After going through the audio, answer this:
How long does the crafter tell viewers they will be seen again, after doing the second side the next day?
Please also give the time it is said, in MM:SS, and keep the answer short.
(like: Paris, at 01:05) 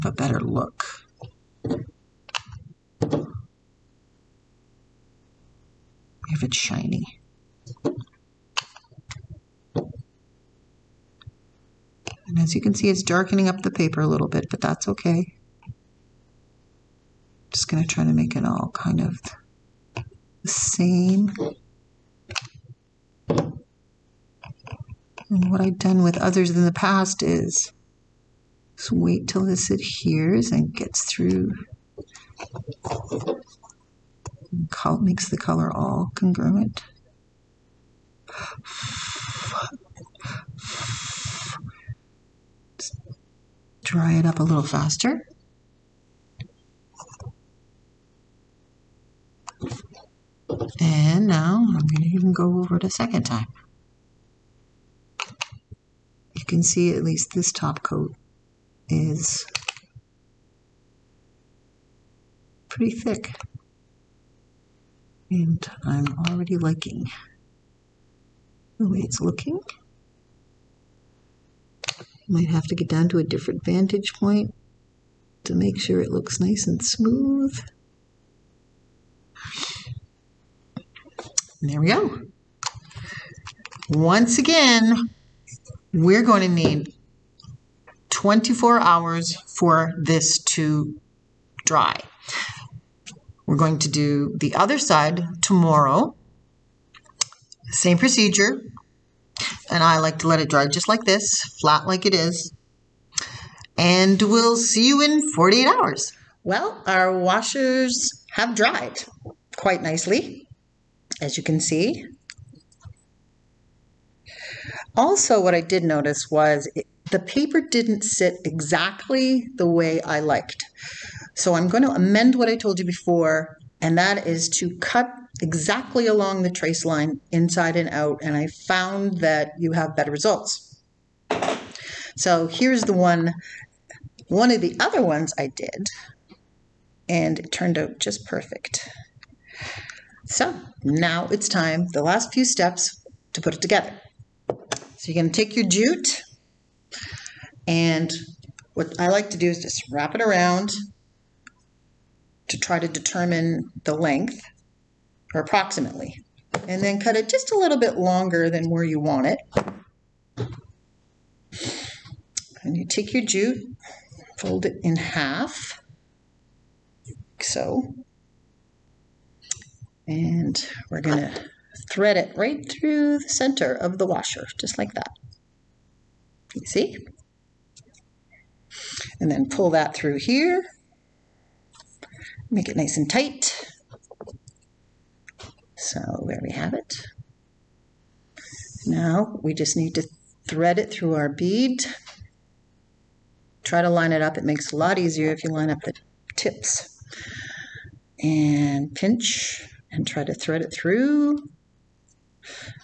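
48 hours, at 01:45.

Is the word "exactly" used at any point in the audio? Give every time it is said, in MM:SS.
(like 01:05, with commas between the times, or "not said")
01:58, 02:05.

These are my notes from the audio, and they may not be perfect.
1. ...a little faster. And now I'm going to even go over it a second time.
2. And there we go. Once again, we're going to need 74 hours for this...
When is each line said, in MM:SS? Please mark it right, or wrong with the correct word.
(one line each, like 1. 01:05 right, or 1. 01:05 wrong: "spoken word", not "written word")
1. 00:44 right
2. 01:21 wrong: "24", not "74".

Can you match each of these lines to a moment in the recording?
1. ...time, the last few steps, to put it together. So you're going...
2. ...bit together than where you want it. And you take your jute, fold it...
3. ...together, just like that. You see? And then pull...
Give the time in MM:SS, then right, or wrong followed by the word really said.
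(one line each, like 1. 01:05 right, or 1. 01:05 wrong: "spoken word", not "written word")
1. 02:21 right
2. 02:37 wrong: "longer", not "together"
3. 02:54 wrong: "washer", not "together".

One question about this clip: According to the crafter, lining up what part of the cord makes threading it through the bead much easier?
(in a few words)
the tips.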